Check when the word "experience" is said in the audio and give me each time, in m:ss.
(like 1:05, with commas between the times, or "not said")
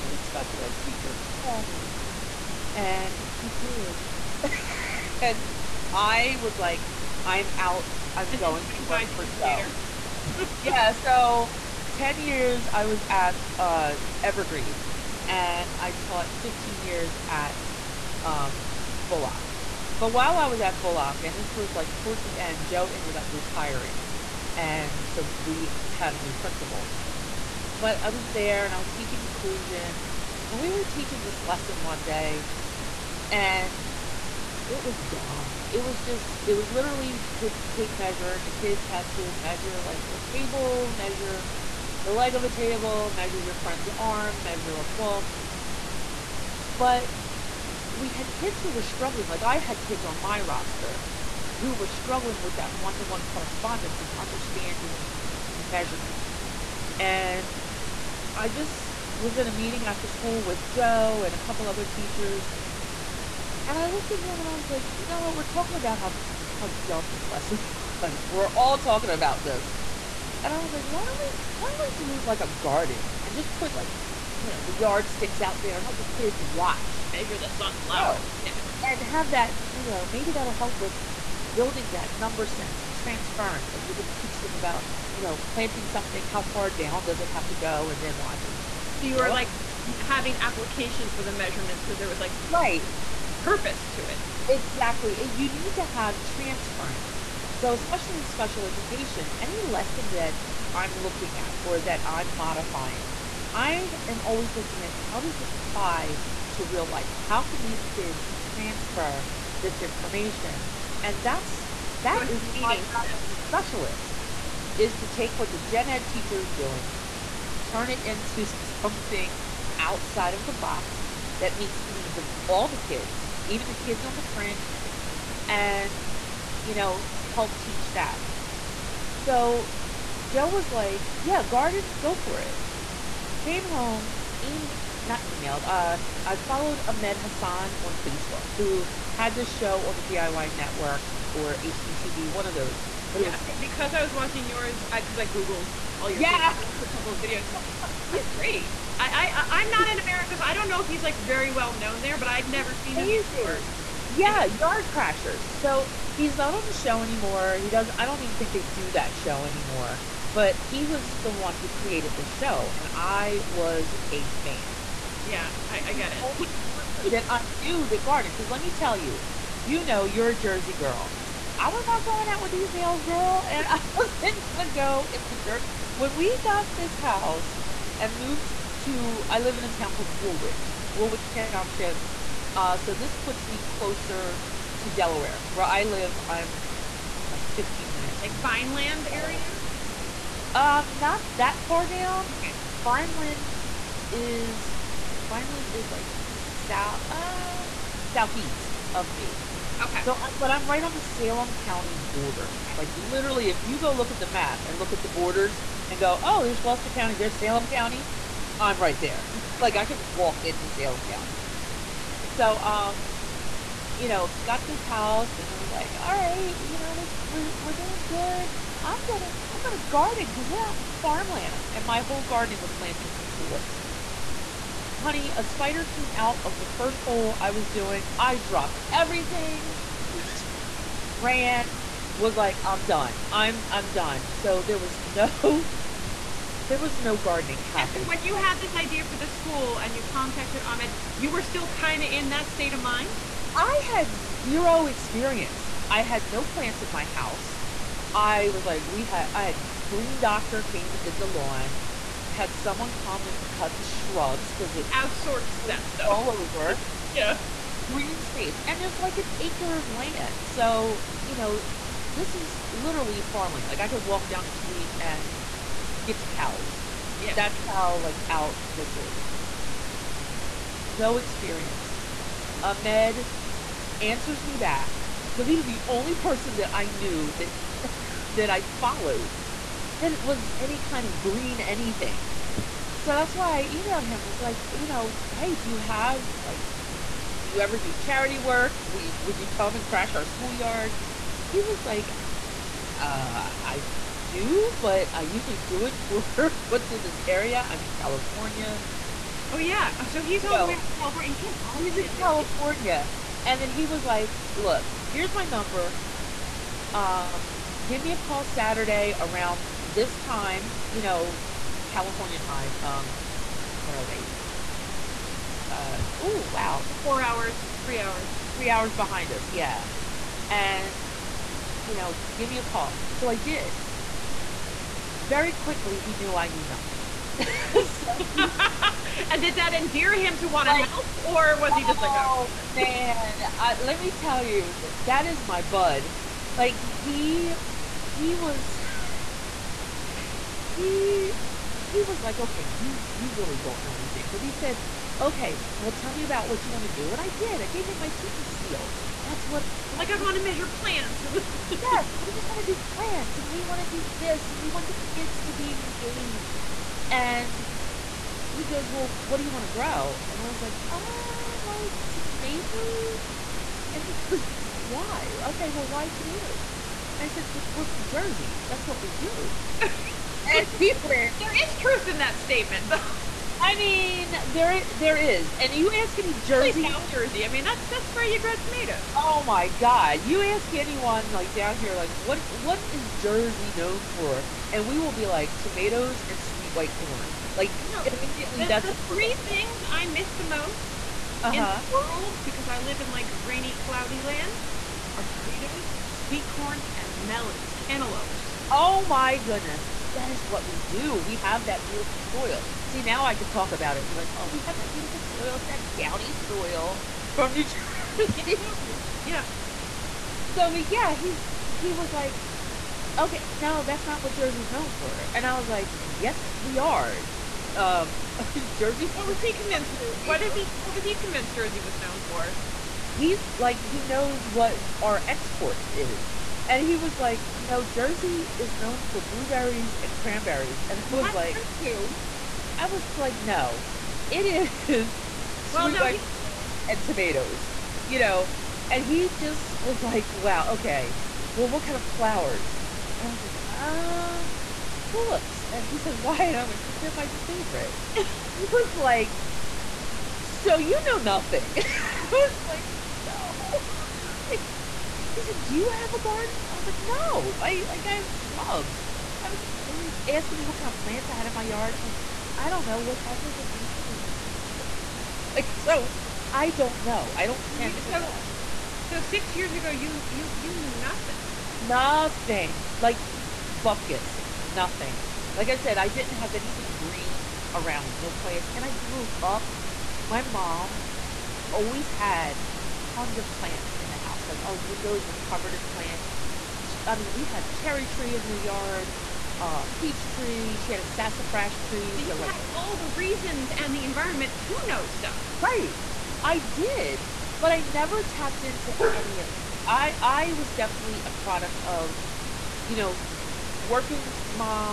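4:04, 4:31.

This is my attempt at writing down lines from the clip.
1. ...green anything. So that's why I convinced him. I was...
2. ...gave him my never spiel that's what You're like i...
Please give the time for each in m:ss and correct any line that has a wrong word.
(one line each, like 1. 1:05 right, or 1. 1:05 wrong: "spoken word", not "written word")
1. 4:41 wrong: "emailed", not "convinced"
2. 5:47 wrong: "teacher", not "never".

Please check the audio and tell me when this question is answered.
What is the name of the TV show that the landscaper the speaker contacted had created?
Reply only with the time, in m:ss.
2:34.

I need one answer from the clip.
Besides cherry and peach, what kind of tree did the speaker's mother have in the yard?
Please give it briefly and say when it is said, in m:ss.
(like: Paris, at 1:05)
sassafras, at 8:11.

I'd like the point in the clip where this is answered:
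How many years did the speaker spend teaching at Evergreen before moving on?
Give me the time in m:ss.
0:11.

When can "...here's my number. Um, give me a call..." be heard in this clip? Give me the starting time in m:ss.
5:05.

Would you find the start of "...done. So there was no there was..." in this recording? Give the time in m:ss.
3:53.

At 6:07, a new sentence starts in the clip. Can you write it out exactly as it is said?
And I said, Because we're from Jersey.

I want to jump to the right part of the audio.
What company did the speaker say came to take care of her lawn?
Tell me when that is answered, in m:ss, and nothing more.
4:09.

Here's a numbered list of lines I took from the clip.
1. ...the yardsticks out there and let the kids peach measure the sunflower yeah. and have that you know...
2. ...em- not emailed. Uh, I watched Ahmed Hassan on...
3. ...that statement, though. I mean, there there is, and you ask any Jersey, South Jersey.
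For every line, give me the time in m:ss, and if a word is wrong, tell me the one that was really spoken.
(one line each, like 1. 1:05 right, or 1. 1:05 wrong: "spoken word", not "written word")
1. 1:14 wrong: "watch", not "peach"
2. 2:14 wrong: "followed", not "watched"
3. 6:12 right.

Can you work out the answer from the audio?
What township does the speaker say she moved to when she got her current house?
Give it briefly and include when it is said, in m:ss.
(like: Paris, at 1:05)
Woolwich Township, at 3:00.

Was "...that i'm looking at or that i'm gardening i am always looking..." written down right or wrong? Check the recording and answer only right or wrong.
wrong.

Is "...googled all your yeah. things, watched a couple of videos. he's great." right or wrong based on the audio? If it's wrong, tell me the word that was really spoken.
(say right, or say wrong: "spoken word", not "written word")
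right.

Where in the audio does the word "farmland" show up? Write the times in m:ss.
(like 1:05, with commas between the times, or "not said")
3:40, 4:23.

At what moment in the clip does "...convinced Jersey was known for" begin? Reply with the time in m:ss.
7:01.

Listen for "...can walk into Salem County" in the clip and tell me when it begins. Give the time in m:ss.
3:29.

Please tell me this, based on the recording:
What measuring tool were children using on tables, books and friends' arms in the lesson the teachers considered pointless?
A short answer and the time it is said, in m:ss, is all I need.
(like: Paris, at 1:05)
tape measure, at 0:37.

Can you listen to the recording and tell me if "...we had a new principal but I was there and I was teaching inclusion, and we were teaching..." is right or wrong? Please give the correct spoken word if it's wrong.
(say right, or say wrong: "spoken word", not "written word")
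right.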